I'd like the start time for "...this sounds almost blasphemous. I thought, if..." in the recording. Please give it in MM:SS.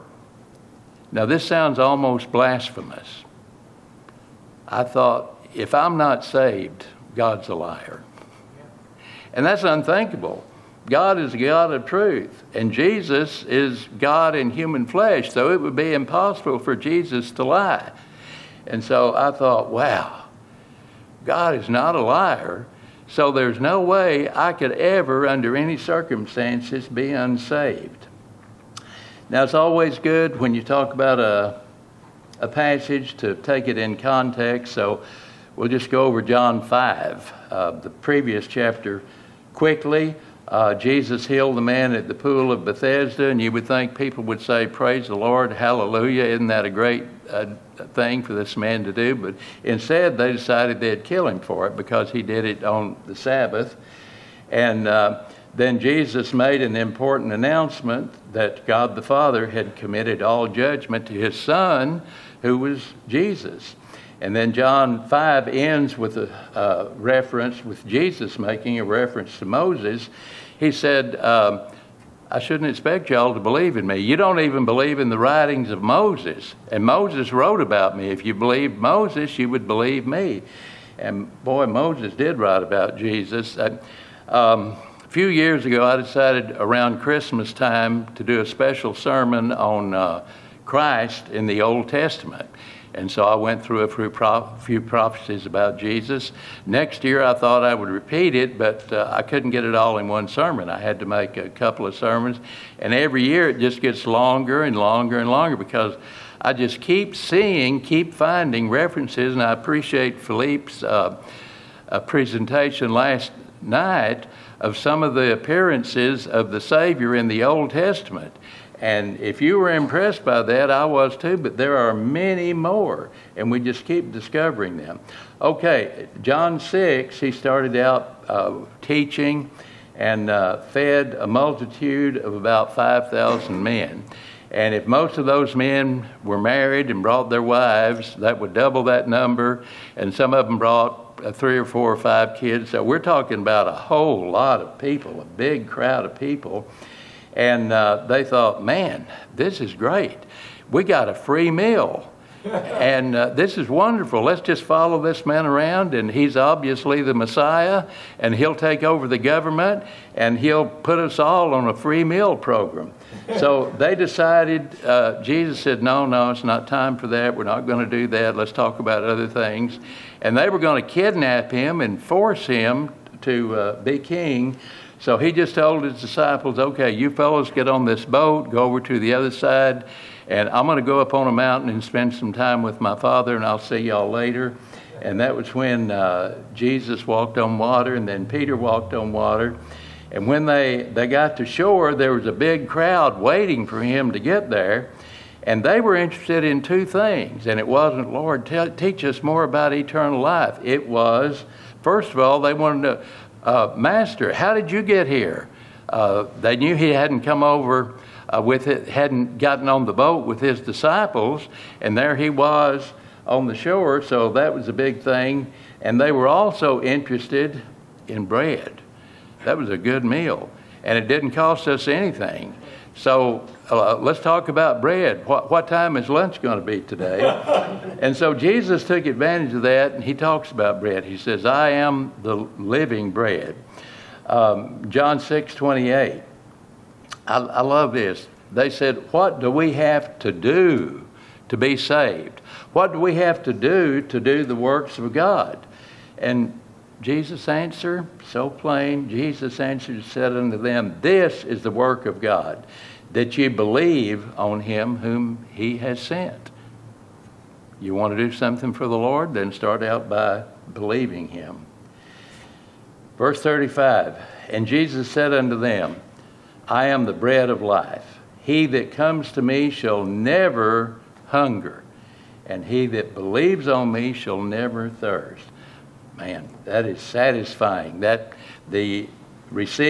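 00:01.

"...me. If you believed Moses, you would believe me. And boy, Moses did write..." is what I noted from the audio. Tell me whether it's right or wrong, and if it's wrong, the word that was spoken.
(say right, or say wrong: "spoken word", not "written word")
right.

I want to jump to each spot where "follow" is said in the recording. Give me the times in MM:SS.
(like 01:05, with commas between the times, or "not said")
02:34.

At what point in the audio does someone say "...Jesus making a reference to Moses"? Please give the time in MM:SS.
01:07.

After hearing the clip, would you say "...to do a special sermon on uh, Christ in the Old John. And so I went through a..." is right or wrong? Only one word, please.
wrong.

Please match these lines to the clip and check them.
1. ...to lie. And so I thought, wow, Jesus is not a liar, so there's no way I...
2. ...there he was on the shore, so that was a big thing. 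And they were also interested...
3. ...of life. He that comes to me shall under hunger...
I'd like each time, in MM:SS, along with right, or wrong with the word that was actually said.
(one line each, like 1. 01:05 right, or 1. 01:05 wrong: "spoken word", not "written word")
1. 00:17 wrong: "God", not "Jesus"
2. 03:31 right
3. 04:27 wrong: "never", not "under".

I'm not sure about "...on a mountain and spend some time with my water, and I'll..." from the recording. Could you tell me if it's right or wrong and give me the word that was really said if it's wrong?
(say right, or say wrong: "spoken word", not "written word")
wrong: "father", not "water".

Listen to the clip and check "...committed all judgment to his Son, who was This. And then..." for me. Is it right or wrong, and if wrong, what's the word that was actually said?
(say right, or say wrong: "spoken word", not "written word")
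wrong: "Jesus", not "This".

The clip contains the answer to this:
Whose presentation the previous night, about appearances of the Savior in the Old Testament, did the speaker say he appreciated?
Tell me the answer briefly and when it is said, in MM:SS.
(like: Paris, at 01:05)
Philippe, at 01:50.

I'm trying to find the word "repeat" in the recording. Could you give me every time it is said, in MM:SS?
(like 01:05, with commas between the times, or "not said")
01:37.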